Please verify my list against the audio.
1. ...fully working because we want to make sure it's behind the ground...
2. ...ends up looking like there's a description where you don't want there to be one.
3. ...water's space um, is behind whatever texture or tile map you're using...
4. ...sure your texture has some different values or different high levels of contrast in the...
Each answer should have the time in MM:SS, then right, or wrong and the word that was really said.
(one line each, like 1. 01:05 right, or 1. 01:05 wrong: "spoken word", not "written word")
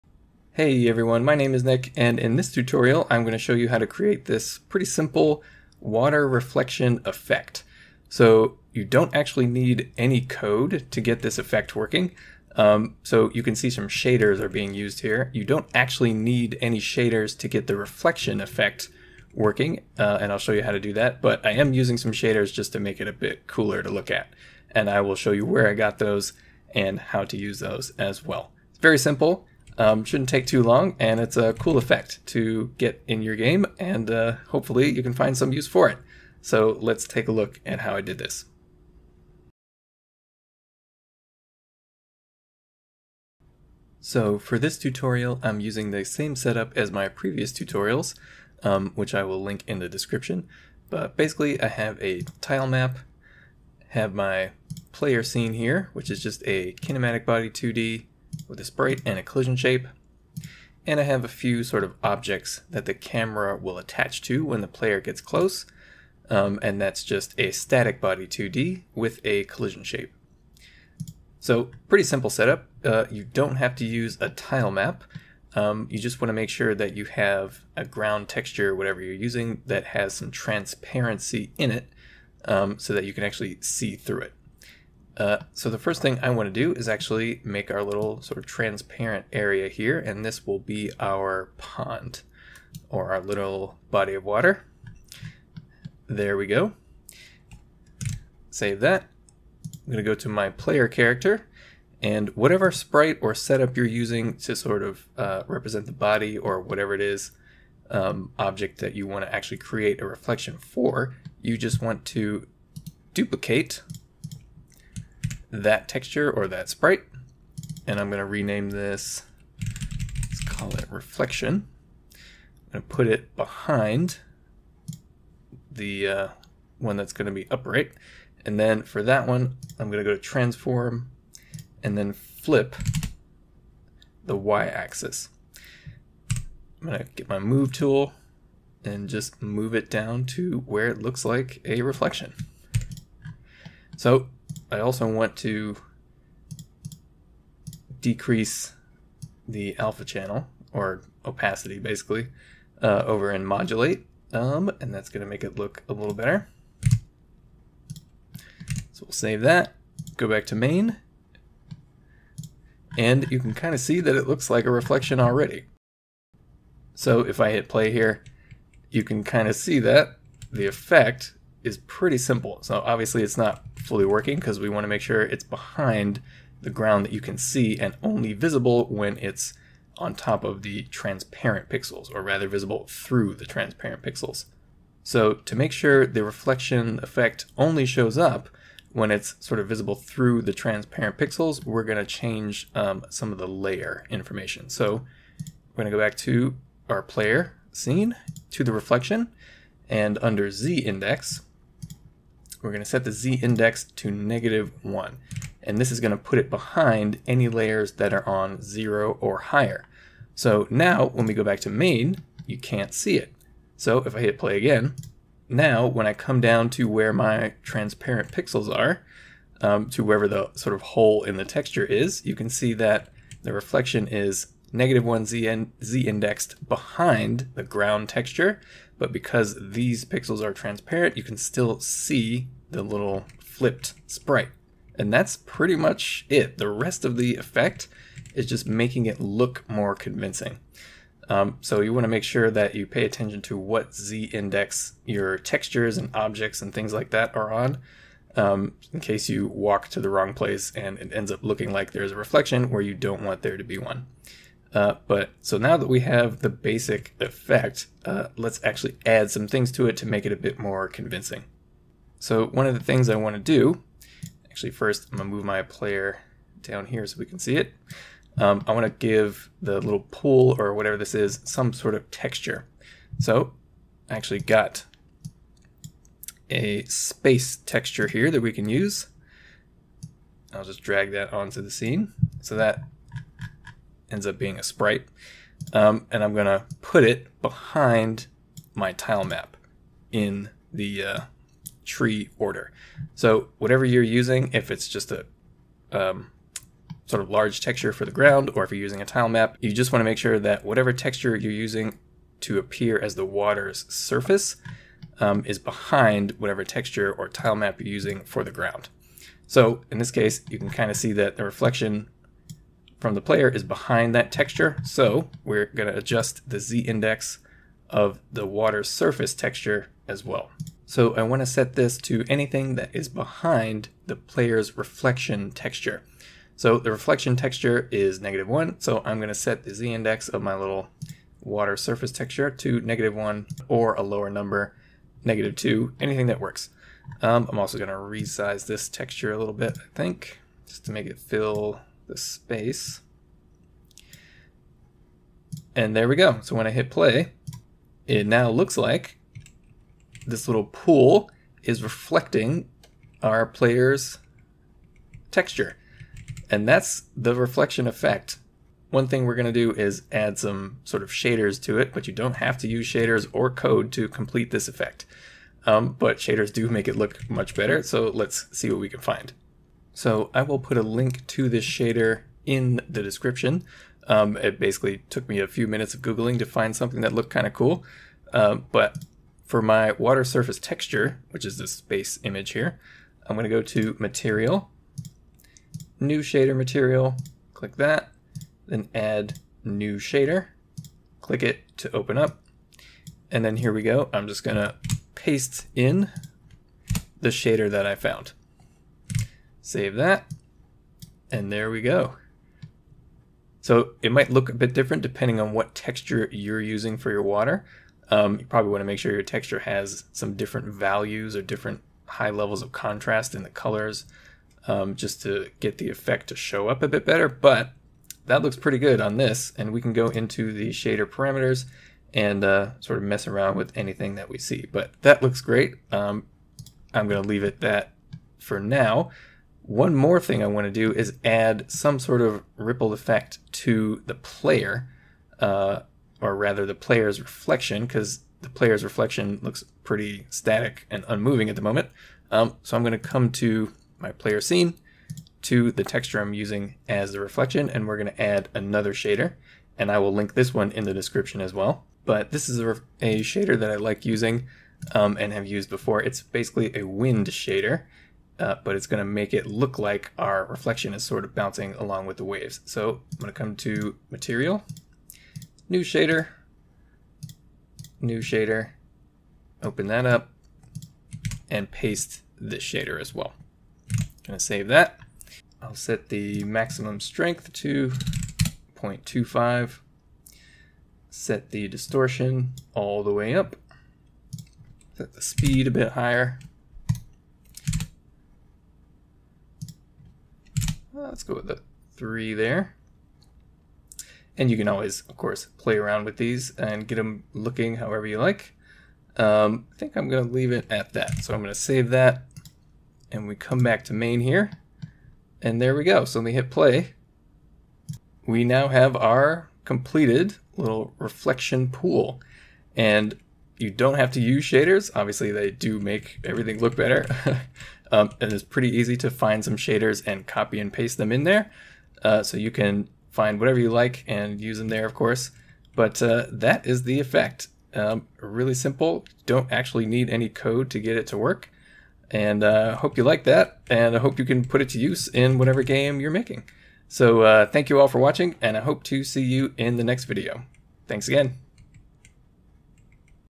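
1. 02:53 right
2. 04:11 wrong: "reflection", not "description"
3. 05:03 wrong: "surface", not "space"
4. 06:48 right.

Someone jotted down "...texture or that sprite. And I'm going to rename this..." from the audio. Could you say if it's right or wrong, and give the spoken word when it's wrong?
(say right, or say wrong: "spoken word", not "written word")
right.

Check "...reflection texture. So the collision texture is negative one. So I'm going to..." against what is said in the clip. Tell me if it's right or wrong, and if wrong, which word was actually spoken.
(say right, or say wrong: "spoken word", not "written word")
wrong: "reflection", not "collision".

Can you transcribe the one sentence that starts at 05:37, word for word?
Um, I'm also going to resize this texture a little bit, I think, just to make it feel the space.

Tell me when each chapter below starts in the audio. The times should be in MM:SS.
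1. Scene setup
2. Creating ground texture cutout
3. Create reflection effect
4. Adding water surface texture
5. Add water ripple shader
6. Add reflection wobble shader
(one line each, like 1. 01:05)
1. 00:45
2. 01:25
3. 01:42
4. 04:15
5. 06:10
6. 07:22.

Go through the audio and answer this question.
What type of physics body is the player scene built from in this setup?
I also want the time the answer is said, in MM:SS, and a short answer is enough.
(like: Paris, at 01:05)
kinematic body 2D, at 00:56.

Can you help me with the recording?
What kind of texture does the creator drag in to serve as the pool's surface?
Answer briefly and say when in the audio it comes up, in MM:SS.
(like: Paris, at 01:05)
space texture, at 04:36.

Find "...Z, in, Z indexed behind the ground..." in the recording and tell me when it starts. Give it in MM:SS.
03:45.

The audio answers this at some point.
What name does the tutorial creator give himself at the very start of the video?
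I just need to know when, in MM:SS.
00:01.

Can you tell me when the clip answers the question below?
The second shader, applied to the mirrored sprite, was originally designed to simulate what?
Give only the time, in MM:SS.
07:36.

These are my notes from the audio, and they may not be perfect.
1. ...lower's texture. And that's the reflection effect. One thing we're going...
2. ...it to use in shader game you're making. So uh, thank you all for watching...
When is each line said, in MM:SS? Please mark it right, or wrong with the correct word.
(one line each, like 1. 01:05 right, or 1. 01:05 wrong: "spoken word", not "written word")
1. 05:53 wrong: "player", not "lower"
2. 08:54 wrong: "whatever", not "shader".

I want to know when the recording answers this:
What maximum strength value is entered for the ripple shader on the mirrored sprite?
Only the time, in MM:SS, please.
07:58.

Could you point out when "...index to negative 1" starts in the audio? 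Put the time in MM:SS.
03:23.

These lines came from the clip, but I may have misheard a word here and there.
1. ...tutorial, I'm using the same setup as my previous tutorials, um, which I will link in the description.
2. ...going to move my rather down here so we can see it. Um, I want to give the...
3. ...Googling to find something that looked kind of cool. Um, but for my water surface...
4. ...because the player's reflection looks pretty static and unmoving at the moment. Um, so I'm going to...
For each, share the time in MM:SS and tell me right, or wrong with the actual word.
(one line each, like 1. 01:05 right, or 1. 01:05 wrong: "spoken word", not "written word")
1. 00:44 right
2. 04:25 wrong: "player", not "rather"
3. 06:16 right
4. 07:17 right.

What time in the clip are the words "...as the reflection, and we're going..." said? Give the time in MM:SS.
07:26.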